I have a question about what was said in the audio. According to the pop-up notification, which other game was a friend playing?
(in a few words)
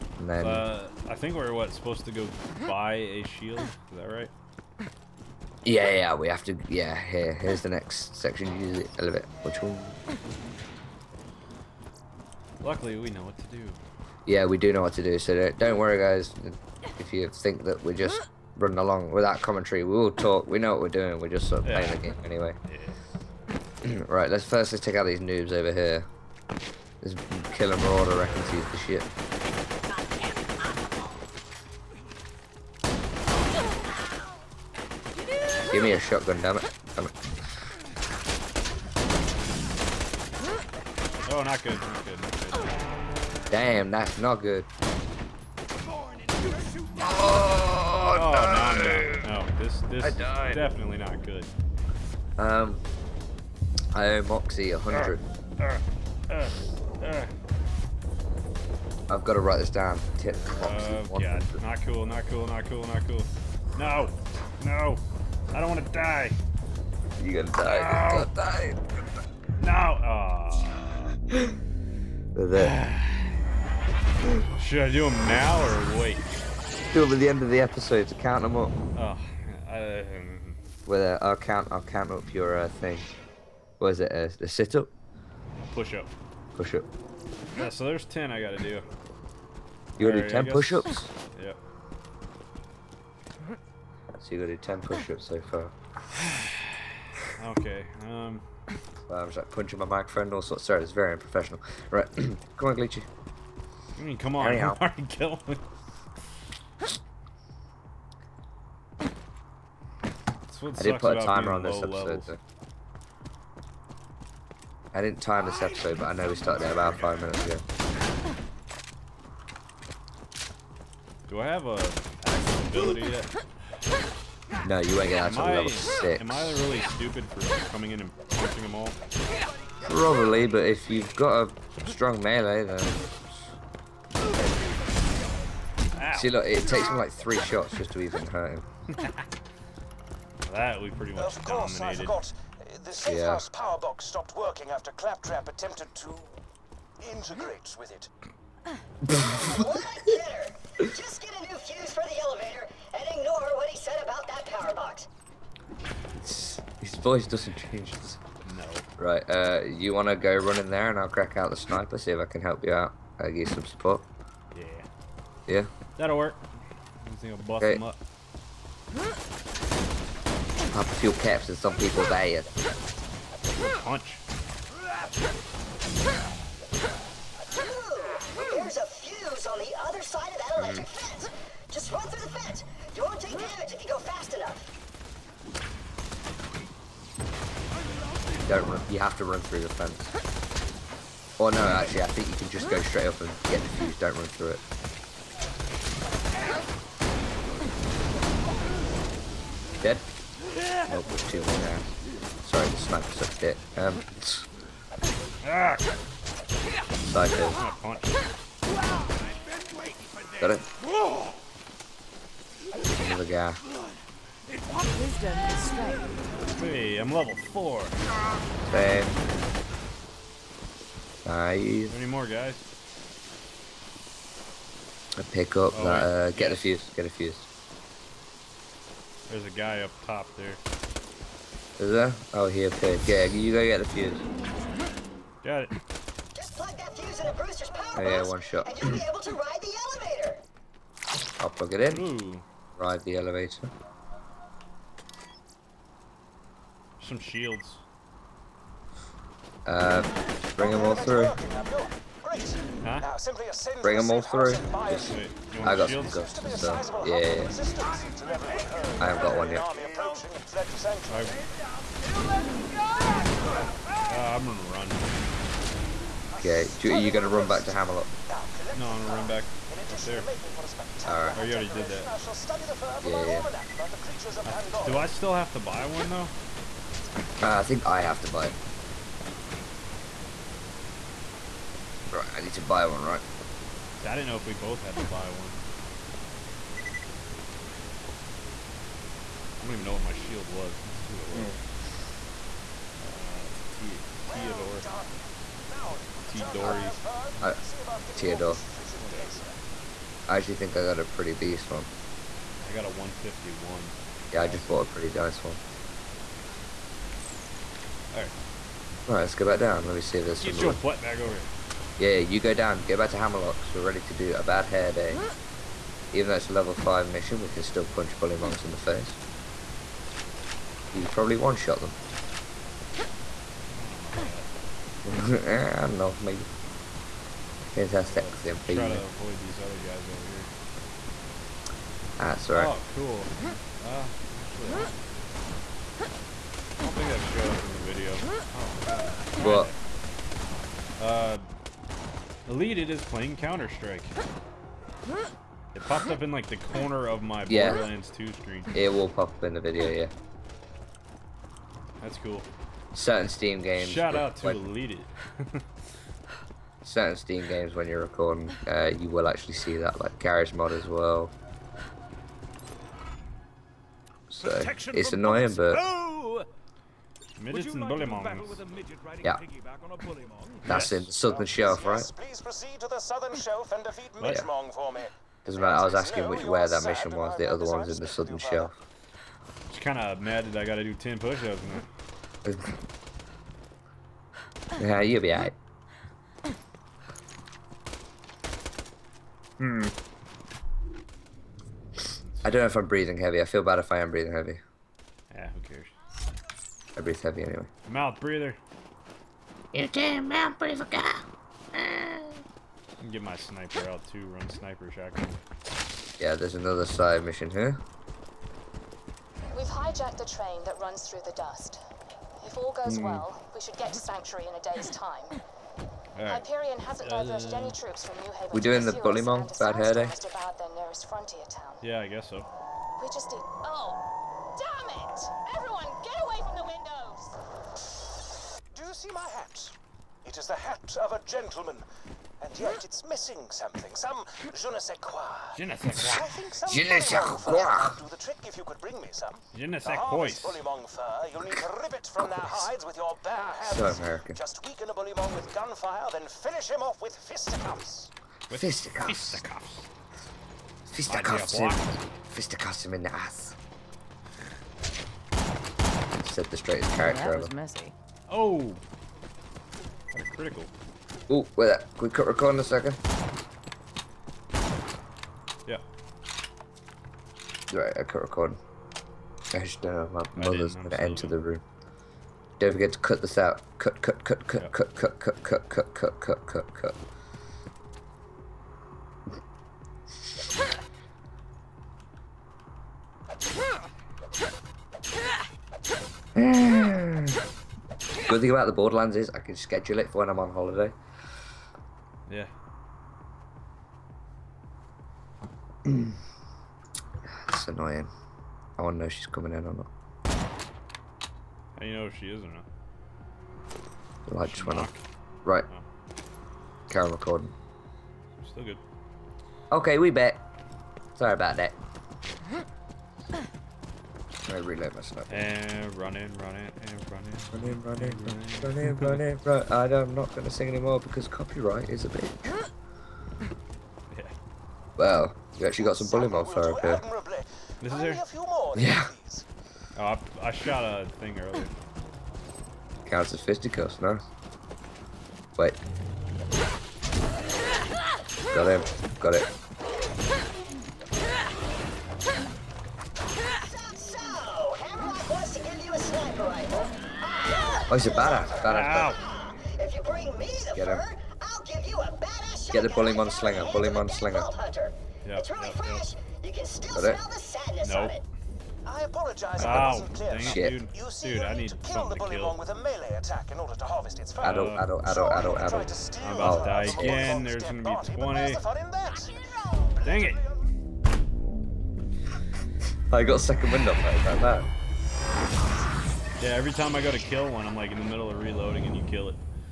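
Counter Strike.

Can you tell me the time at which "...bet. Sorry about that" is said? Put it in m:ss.
8:30.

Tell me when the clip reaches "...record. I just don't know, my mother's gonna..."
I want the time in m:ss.
7:48.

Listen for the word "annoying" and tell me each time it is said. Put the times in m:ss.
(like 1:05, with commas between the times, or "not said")
6:05, 8:17.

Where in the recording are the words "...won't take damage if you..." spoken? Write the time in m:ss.
3:03.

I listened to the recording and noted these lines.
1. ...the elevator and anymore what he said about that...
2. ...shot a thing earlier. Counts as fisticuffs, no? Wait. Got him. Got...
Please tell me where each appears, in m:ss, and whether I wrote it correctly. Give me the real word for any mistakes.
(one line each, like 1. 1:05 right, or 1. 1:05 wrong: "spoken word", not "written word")
1. 2:32 wrong: "ignore", not "anymore"
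2. 8:50 right.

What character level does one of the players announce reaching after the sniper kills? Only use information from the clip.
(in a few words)
4.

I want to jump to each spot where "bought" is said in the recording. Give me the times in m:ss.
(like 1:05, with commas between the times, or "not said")
5:04.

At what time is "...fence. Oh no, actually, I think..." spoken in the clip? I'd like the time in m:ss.
3:09.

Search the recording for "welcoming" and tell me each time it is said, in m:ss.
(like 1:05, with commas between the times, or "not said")
not said.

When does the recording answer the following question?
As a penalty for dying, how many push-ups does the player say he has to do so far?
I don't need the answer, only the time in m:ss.
1:27.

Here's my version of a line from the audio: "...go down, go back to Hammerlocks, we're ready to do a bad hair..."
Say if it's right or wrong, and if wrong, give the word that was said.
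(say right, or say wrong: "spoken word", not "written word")
right.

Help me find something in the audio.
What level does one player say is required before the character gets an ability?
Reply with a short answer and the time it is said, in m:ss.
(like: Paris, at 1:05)
6, at 2:05.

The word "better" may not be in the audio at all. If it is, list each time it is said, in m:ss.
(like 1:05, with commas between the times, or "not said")
2:30.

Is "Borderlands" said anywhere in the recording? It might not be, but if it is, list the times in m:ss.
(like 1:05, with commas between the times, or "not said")
5:47, 8:08.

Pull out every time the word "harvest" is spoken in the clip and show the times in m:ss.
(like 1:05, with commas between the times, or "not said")
9:23.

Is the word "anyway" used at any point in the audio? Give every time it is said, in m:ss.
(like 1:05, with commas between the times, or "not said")
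0:22, 6:37.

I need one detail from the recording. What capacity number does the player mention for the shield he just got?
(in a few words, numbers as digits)
151.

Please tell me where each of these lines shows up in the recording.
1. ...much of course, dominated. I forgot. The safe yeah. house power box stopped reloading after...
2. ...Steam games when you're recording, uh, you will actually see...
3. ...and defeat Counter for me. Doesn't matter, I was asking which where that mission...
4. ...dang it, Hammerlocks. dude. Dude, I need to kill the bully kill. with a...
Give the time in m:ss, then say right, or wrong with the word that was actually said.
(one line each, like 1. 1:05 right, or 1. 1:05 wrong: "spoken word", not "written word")
1. 2:21 wrong: "working", not "reloading"
2. 5:57 right
3. 6:13 wrong: "Midgemong", not "Counter"
4. 9:20 wrong: "Shit", not "Hammerlocks".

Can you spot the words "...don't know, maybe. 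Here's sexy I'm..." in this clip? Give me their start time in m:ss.
5:25.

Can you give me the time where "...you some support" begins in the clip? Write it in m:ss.
2:43.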